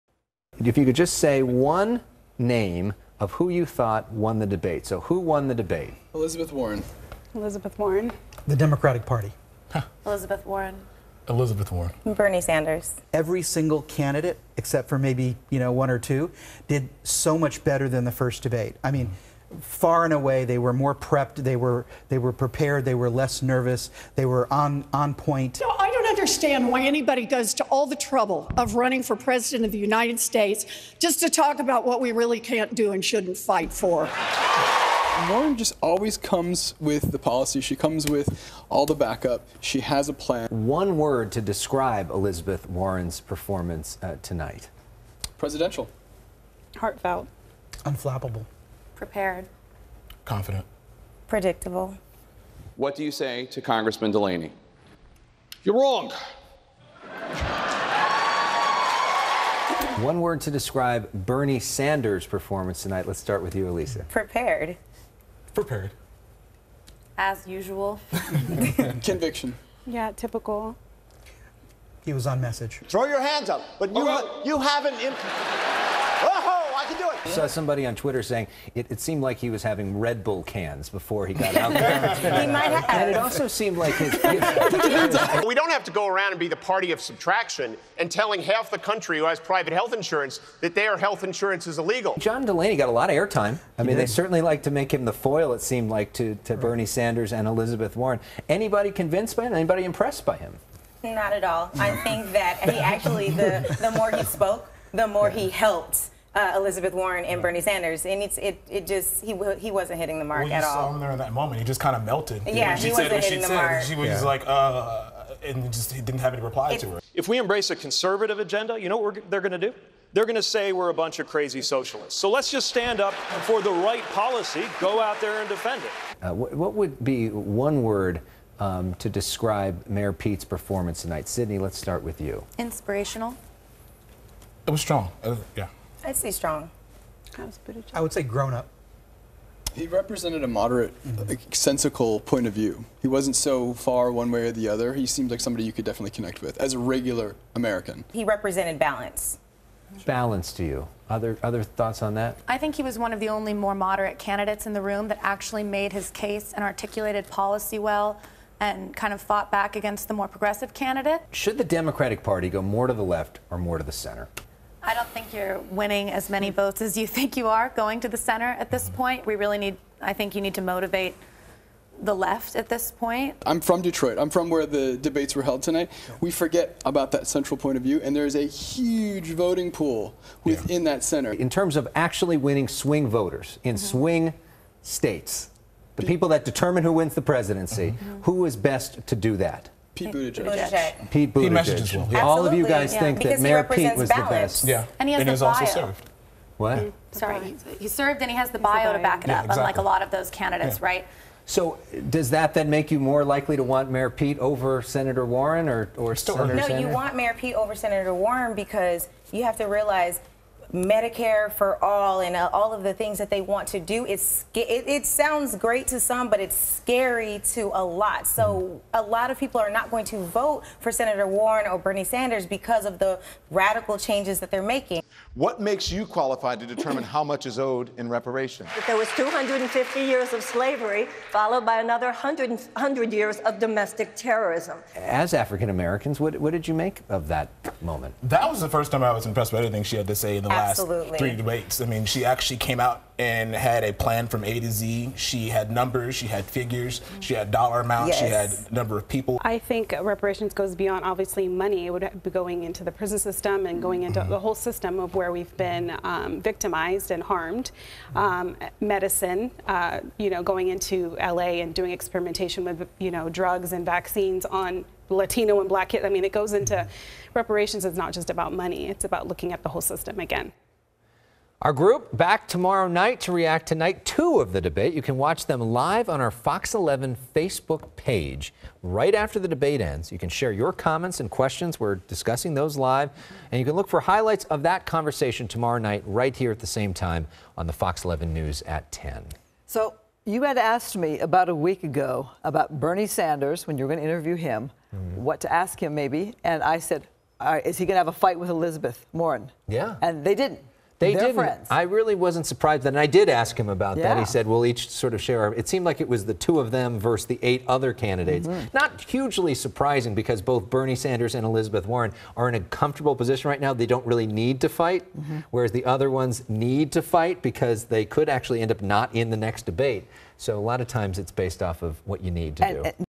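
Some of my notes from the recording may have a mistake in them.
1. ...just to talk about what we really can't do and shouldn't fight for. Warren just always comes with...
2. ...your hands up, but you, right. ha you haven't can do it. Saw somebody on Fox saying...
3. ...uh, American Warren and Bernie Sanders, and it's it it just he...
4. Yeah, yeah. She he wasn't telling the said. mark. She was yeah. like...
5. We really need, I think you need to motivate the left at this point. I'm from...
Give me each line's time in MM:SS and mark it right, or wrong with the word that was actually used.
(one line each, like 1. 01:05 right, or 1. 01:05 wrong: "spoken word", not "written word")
1. 00:30 right
2. 01:13 wrong: "Twitter", not "Fox"
3. 01:46 wrong: "Elizabeth", not "American"
4. 01:52 wrong: "hitting", not "telling"
5. 02:49 right.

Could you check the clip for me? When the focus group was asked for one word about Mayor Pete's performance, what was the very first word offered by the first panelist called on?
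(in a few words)
Inspirational.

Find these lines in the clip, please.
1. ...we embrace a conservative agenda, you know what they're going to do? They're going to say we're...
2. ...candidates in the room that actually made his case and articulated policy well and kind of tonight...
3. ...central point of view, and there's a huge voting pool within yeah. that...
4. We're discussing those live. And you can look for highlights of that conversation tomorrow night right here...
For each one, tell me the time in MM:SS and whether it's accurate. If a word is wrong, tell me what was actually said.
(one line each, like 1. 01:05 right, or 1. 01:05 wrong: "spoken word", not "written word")
1. 01:57 right
2. 02:34 wrong: "fought", not "tonight"
3. 02:57 right
4. 04:41 right.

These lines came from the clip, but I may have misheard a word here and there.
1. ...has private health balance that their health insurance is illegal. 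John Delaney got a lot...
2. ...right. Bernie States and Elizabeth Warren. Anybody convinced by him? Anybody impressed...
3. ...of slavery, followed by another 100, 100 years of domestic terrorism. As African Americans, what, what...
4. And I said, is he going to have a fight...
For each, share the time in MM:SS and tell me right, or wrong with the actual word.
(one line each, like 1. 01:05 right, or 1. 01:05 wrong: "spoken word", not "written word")
1. 01:29 wrong: "insurance", not "balance"
2. 01:36 wrong: "Sanders", not "States"
3. 03:50 right
4. 04:56 right.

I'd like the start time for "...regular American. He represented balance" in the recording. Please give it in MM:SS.
02:26.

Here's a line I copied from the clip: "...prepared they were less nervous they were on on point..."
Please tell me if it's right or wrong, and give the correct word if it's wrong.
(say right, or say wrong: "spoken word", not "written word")
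right.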